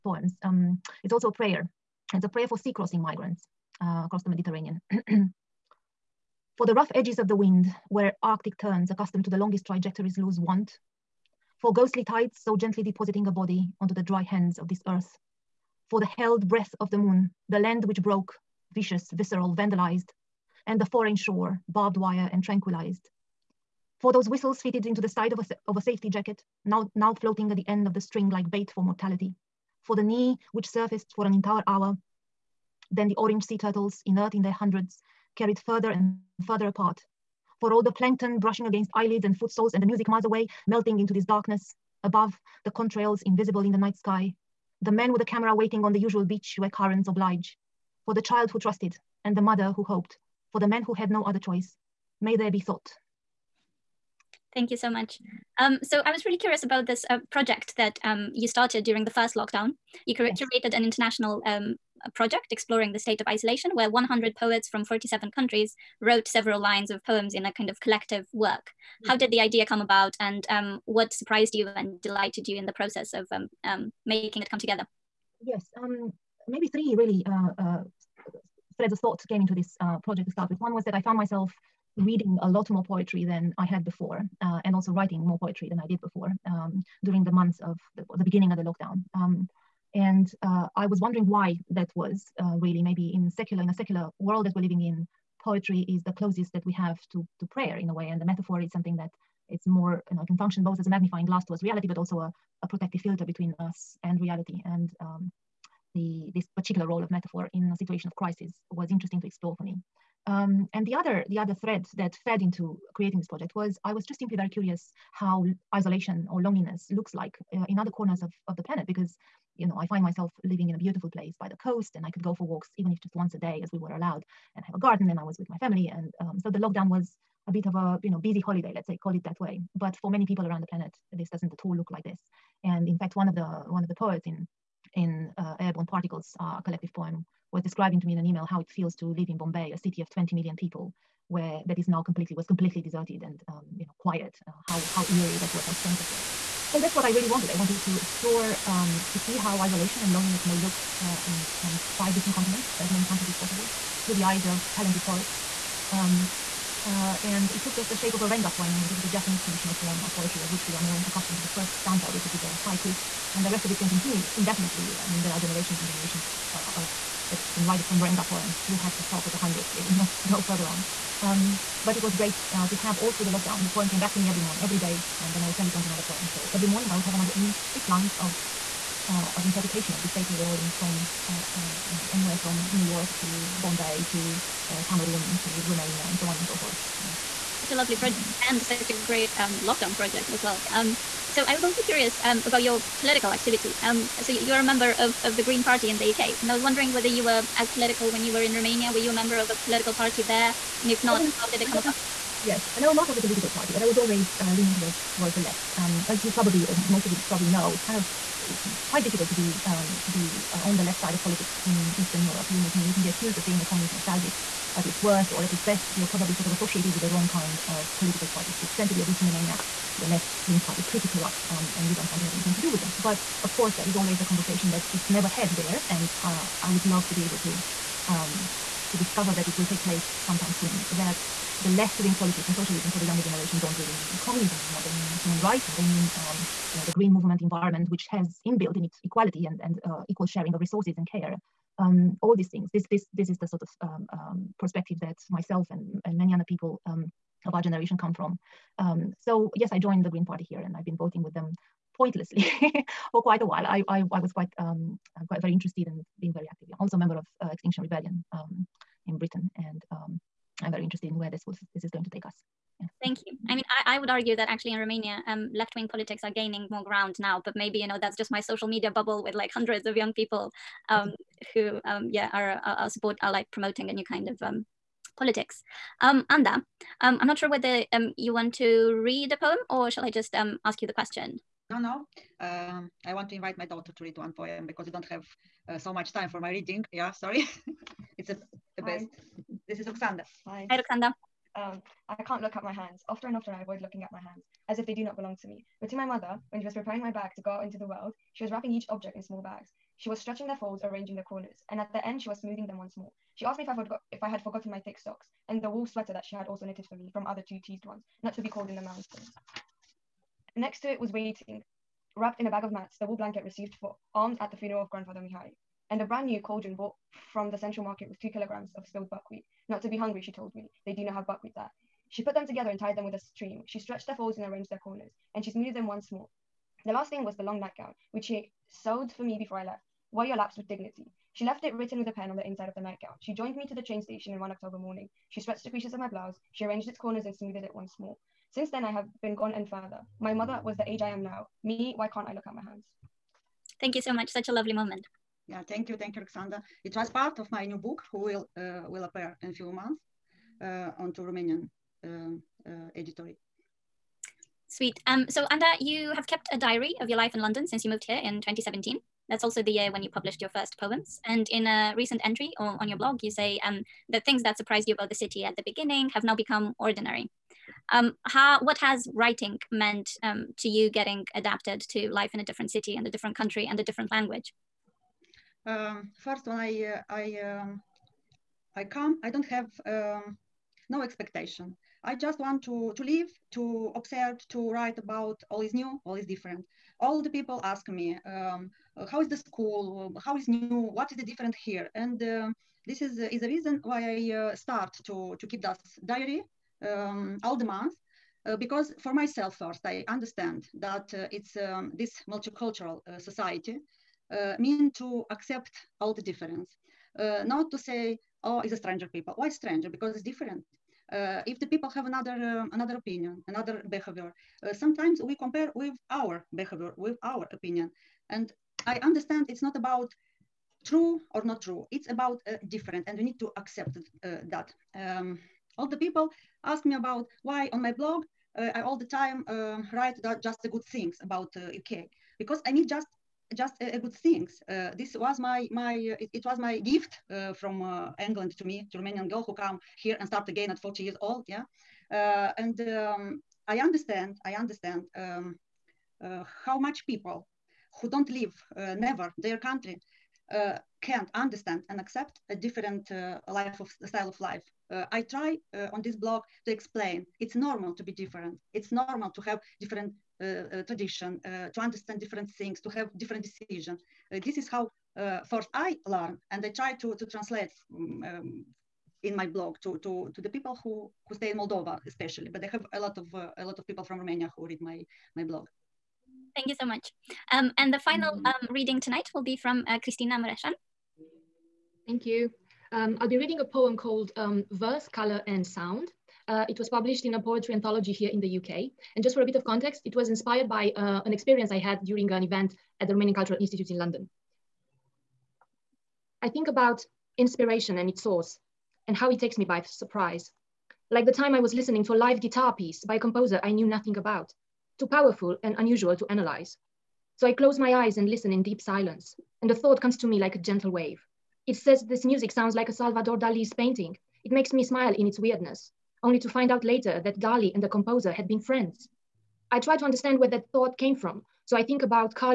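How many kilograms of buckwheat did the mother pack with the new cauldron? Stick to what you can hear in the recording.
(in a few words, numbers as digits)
2.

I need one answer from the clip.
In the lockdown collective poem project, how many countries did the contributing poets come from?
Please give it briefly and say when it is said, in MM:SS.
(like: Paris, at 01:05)
47, at 01:04.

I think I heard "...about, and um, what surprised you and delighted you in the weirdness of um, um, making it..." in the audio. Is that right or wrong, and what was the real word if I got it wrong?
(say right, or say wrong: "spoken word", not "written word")
wrong: "process", not "weirdness".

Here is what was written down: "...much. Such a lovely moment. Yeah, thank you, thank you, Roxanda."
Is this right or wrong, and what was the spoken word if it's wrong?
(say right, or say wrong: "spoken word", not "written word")
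wrong: "Alexander", not "Roxanda".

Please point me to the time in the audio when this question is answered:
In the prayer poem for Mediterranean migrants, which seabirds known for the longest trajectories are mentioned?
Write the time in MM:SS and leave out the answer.
00:08.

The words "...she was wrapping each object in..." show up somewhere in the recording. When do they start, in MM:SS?
04:58.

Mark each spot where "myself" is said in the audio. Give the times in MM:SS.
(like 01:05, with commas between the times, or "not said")
01:21, 02:00, 04:05, 06:39.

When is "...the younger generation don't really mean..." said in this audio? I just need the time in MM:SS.
03:52.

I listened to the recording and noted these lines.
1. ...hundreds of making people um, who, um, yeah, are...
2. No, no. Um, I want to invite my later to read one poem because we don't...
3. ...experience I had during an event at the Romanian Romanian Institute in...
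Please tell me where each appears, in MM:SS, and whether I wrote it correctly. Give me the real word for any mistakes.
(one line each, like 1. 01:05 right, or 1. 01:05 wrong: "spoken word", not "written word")
1. 04:29 wrong: "young", not "making"
2. 04:41 wrong: "daughter", not "later"
3. 08:11 wrong: "Cultural", not "Romanian".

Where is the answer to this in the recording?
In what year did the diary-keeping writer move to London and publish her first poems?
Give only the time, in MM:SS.
05:58.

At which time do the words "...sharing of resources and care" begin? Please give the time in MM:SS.
04:00.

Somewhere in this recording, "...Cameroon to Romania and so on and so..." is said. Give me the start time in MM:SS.
03:04.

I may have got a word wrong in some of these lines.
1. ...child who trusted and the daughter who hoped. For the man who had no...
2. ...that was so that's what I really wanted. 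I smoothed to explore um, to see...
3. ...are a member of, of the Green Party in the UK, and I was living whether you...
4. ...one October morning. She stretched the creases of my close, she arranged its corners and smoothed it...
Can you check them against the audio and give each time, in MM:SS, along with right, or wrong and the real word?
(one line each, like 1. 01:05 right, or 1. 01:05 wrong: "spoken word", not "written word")
1. 00:48 wrong: "mother", not "daughter"
2. 02:25 wrong: "wanted", not "smoothed"
3. 03:14 wrong: "wondering", not "living"
4. 05:34 wrong: "blouse", not "close".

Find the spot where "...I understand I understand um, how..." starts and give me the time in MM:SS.
07:23.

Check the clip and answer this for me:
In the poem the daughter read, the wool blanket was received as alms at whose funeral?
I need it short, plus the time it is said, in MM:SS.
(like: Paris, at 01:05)
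Grandfather Mihai, at 05:14.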